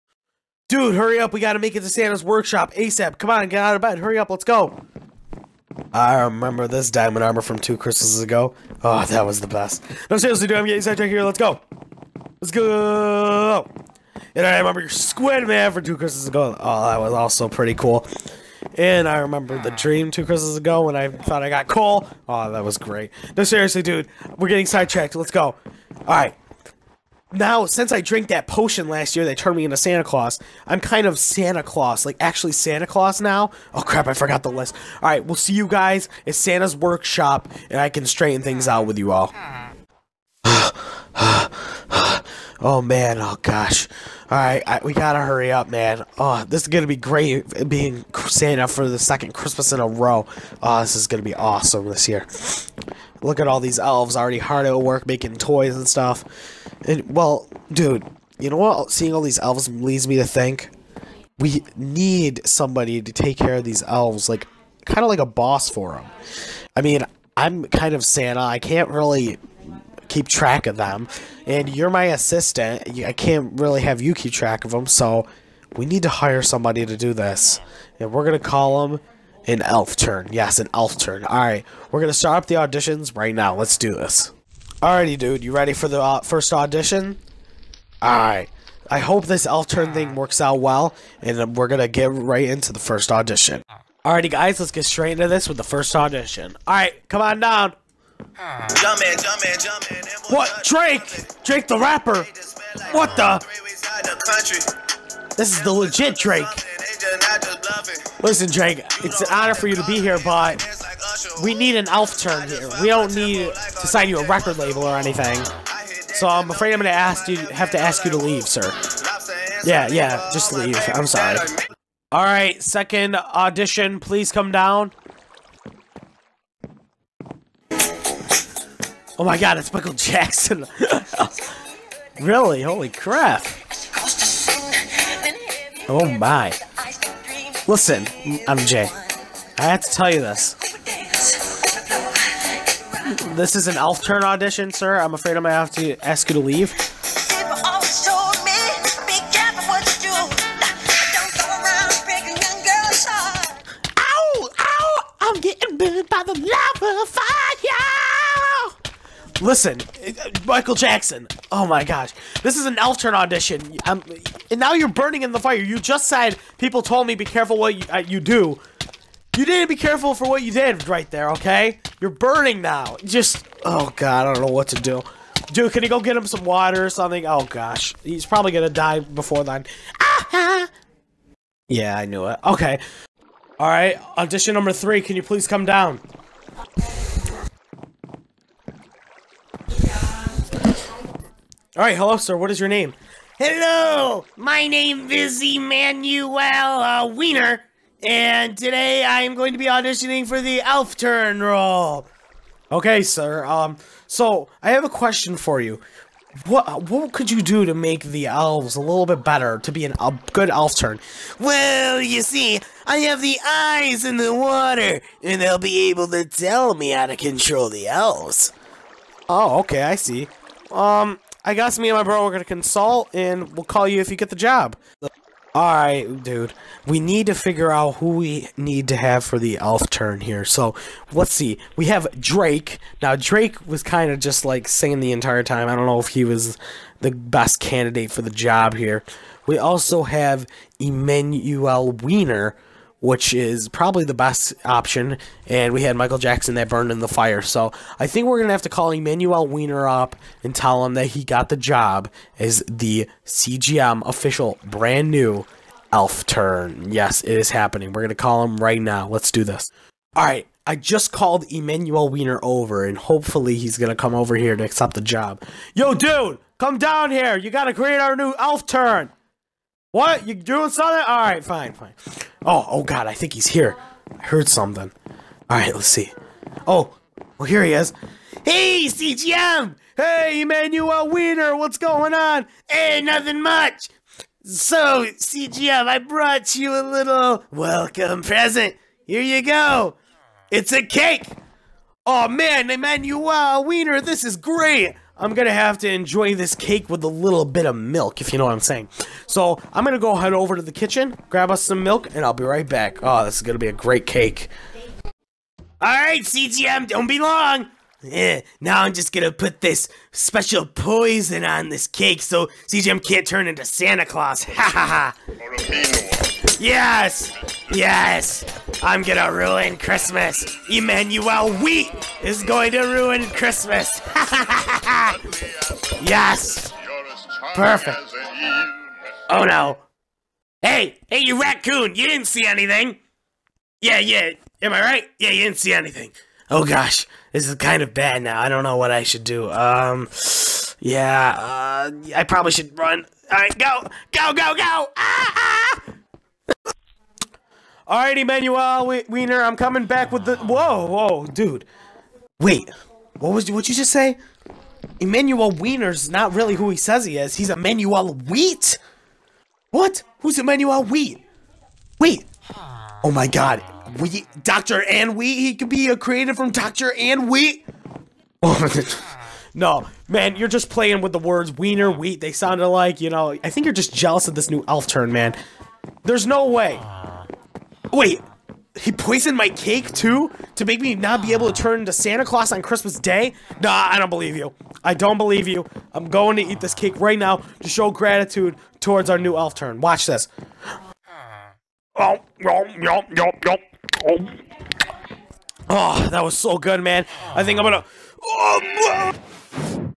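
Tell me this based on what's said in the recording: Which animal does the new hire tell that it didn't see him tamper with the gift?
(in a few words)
Raccoon.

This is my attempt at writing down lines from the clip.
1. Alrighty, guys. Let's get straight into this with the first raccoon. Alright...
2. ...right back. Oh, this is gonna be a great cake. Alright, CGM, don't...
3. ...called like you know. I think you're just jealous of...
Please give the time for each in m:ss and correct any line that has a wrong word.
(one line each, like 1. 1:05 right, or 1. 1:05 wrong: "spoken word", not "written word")
1. 1:34 wrong: "audition", not "raccoon"
2. 5:02 right
3. 6:12 wrong: "sounded", not "called".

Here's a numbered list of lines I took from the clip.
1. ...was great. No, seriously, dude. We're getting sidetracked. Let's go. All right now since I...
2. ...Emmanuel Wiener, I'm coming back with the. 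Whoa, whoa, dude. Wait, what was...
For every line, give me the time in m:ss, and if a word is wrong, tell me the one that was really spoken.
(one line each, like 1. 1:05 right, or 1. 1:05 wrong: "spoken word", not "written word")
1. 0:22 right
2. 5:48 right.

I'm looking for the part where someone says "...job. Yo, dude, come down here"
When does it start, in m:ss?
4:25.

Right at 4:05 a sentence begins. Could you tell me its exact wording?
And we had Michael Jackson that burned in the fire.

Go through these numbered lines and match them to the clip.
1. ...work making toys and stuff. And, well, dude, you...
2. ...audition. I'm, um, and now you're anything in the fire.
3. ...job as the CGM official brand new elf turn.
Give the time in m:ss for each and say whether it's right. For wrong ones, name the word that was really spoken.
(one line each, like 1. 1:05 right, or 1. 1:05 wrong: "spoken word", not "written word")
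1. 0:54 right
2. 2:43 wrong: "burning", not "anything"
3. 4:11 right.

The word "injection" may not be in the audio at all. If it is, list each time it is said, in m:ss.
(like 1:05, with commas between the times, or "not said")
not said.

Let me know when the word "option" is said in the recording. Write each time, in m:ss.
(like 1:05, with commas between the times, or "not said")
4:04.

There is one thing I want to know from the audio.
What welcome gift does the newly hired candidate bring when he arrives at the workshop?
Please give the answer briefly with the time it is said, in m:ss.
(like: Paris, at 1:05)
A cake, at 4:50.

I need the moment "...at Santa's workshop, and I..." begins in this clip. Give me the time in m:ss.
0:36.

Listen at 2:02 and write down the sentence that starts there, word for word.
All right, second audition, please come down.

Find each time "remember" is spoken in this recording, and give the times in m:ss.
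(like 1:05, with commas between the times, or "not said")
0:06, 0:14, 0:19.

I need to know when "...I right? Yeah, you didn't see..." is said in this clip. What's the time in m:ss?
5:34.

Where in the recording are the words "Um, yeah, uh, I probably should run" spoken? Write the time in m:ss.
5:39.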